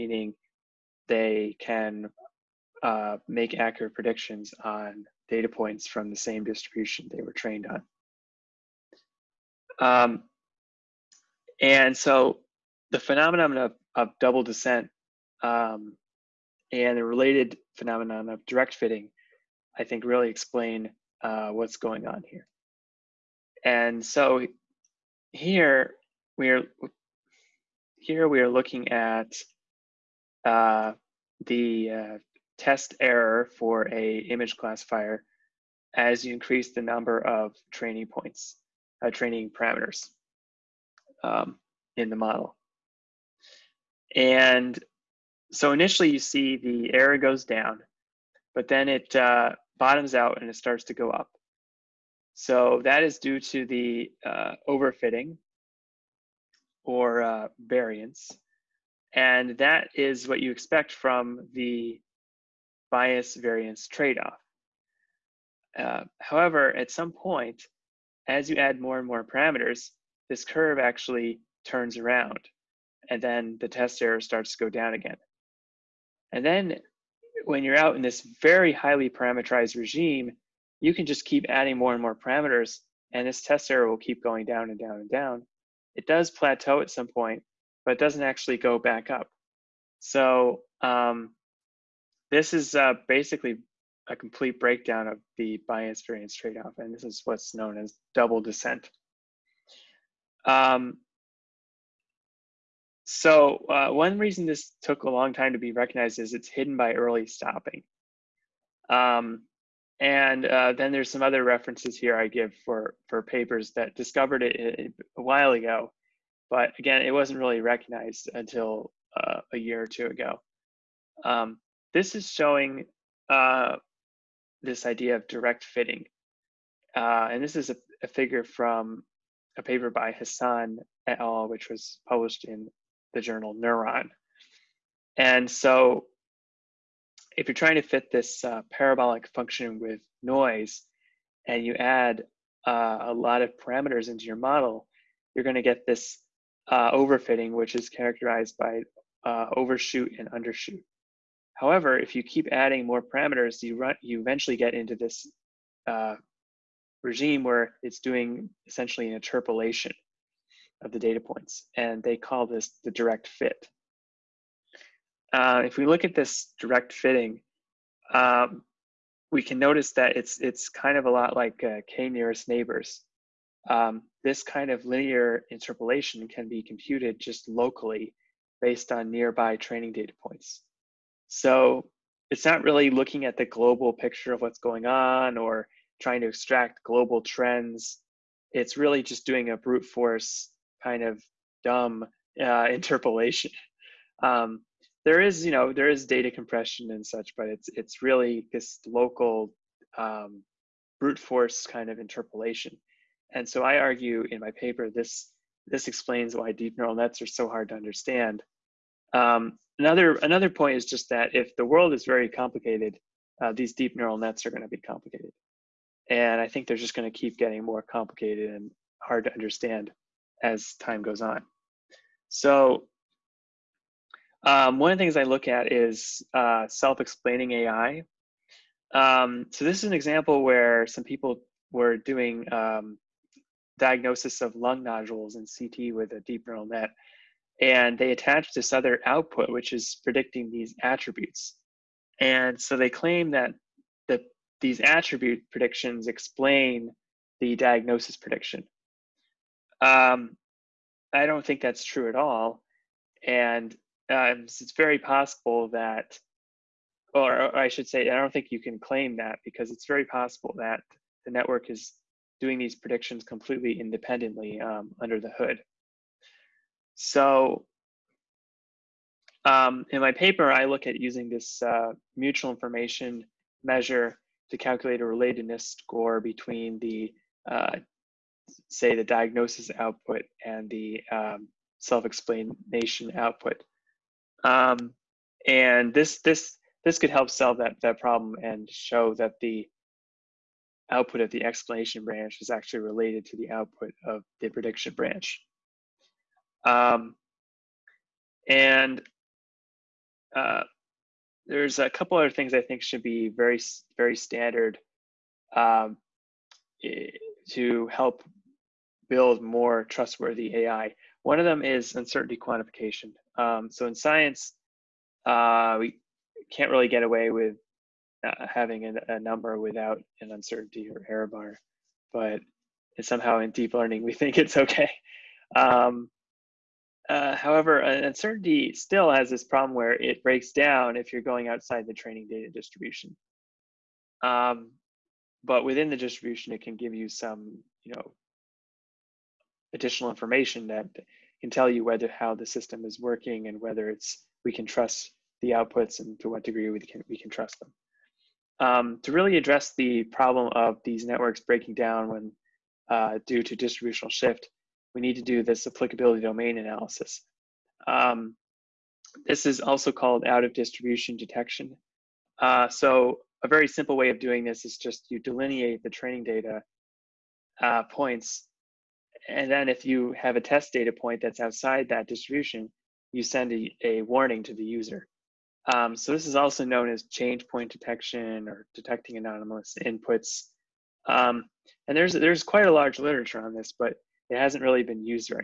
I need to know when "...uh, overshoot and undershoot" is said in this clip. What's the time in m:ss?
2:29.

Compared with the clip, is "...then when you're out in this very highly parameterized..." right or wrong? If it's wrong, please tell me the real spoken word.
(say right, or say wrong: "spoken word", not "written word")
right.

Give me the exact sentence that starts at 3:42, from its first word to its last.
So um, one of the things I look at is uh, self-explaining AI.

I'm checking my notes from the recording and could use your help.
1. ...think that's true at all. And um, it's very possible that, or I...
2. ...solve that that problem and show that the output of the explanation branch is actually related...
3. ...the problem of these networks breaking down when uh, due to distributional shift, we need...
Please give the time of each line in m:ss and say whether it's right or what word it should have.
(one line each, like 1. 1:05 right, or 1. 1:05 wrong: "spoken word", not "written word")
1. 4:11 right
2. 4:47 right
3. 5:49 right.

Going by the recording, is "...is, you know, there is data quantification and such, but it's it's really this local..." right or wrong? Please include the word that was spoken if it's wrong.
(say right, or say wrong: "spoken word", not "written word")
wrong: "compression", not "quantification".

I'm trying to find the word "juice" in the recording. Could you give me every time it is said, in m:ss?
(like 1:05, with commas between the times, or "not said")
not said.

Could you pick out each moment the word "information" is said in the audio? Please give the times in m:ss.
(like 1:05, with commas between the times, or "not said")
4:32, 5:40.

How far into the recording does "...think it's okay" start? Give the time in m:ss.
5:24.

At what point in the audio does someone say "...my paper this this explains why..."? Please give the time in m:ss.
3:24.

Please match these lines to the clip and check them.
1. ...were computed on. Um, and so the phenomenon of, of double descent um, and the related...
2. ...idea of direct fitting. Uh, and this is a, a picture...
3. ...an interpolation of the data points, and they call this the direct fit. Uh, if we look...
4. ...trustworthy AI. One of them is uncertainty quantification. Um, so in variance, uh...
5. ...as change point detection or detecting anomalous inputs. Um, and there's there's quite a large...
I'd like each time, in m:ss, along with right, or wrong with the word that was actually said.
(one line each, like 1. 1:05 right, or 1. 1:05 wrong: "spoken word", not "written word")
1. 0:07 wrong: "trained", not "computed"
2. 2:04 wrong: "figure", not "picture"
3. 2:39 right
4. 5:09 wrong: "science", not "variance"
5. 6:16 right.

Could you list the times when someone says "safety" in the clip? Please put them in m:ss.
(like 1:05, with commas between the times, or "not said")
not said.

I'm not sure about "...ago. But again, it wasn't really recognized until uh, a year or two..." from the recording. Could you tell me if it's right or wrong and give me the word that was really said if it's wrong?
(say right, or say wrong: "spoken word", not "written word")
right.